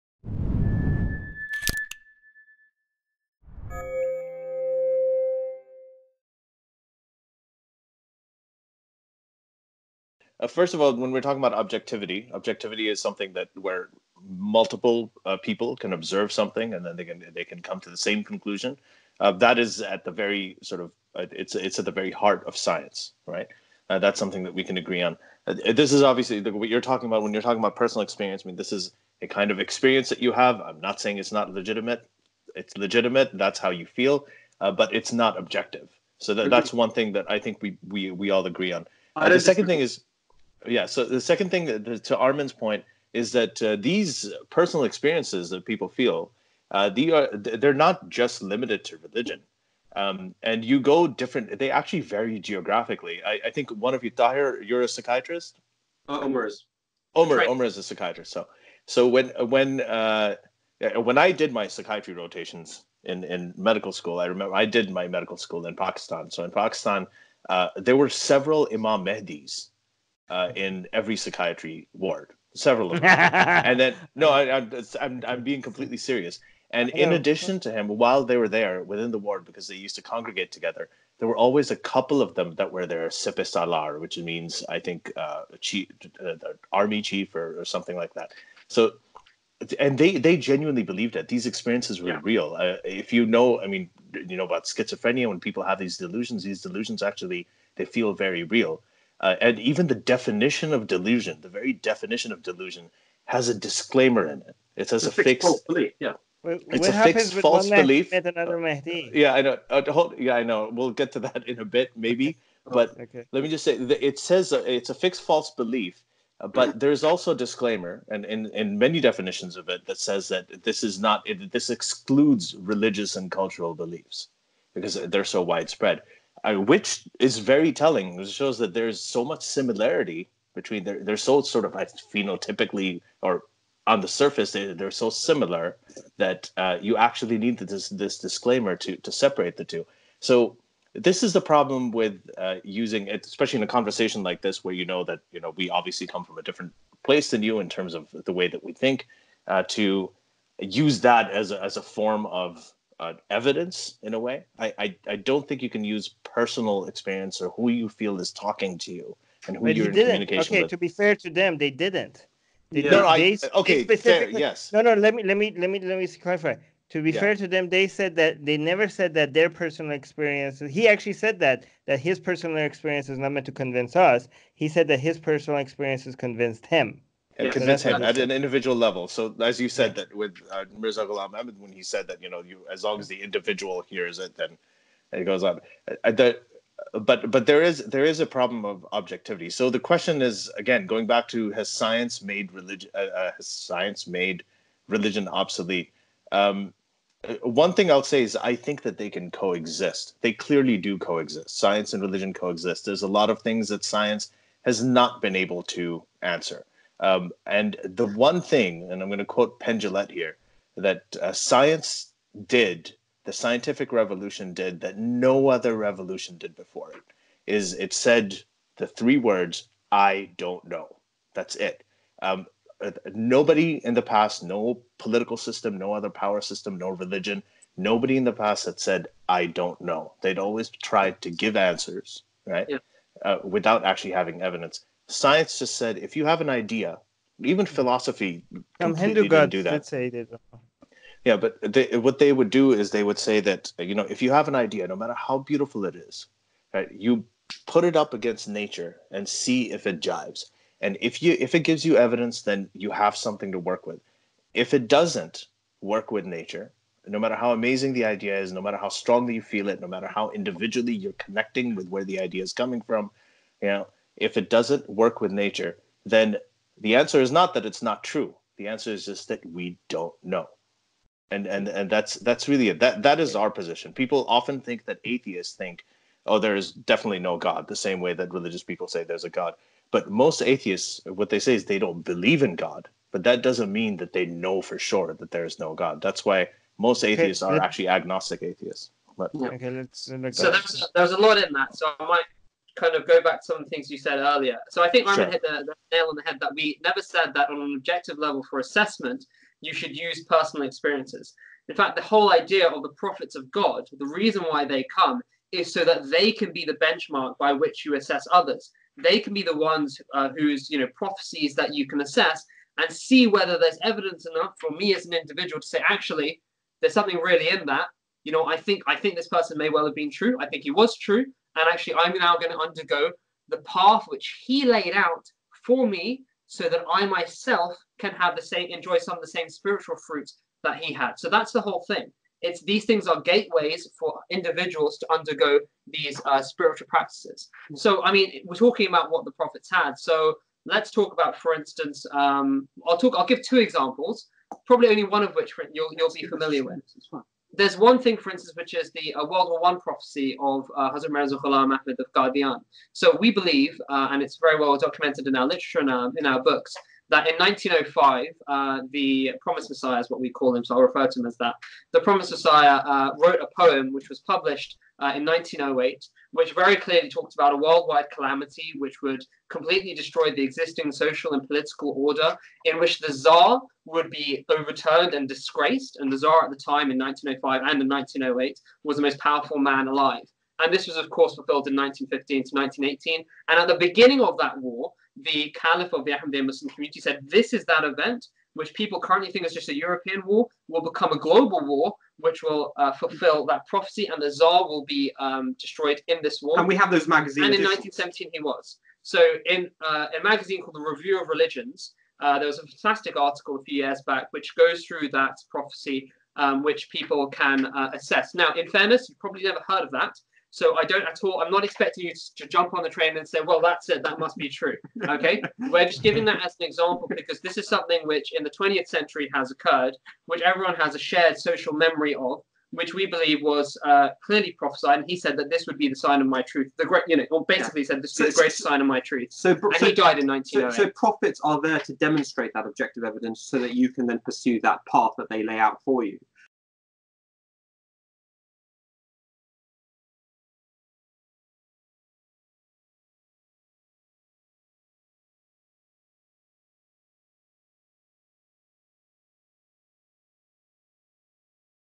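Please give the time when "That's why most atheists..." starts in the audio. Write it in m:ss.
4:46.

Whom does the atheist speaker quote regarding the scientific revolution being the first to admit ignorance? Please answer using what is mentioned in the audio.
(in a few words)
Penn Jillette.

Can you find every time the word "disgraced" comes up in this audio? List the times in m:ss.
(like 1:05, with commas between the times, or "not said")
6:15.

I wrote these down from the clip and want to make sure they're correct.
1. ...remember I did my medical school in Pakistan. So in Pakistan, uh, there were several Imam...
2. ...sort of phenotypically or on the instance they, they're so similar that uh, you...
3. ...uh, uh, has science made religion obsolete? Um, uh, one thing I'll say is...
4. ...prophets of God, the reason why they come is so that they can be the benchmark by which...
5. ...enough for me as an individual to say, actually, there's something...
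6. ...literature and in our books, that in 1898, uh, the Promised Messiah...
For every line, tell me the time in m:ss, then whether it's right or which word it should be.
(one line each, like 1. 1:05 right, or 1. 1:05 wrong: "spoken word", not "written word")
1. 1:04 right
2. 2:11 wrong: "surface", not "instance"
3. 3:12 right
4. 5:02 right
5. 5:14 right
6. 5:55 wrong: "1905", not "1898".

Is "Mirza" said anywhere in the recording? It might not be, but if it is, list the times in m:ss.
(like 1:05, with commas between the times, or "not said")
3:00, 5:51.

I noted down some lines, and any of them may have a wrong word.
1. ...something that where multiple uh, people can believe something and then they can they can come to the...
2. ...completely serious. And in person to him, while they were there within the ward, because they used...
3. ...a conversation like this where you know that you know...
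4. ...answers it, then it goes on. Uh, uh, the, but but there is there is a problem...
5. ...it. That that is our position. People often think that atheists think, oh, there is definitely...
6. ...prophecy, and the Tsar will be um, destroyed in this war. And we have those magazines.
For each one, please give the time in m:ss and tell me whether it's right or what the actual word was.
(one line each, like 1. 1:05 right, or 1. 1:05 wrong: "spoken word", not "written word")
1. 0:12 wrong: "observe", not "believe"
2. 1:15 wrong: "addition", not "person"
3. 2:23 right
4. 3:03 wrong: "hears", not "answers"
5. 4:32 right
6. 6:33 right.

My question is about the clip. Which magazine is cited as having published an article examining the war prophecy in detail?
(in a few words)
The Review of Religions.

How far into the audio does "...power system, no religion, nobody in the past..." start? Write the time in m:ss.
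3:46.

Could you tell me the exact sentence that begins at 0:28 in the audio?
I mean, this is a kind of experience that you have.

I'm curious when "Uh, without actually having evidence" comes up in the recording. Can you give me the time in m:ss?
3:53.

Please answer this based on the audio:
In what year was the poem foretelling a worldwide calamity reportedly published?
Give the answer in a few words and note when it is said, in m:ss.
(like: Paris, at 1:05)
1908, at 6:04.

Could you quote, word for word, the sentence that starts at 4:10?
And if you if it gives you evidence, then you have something to work with.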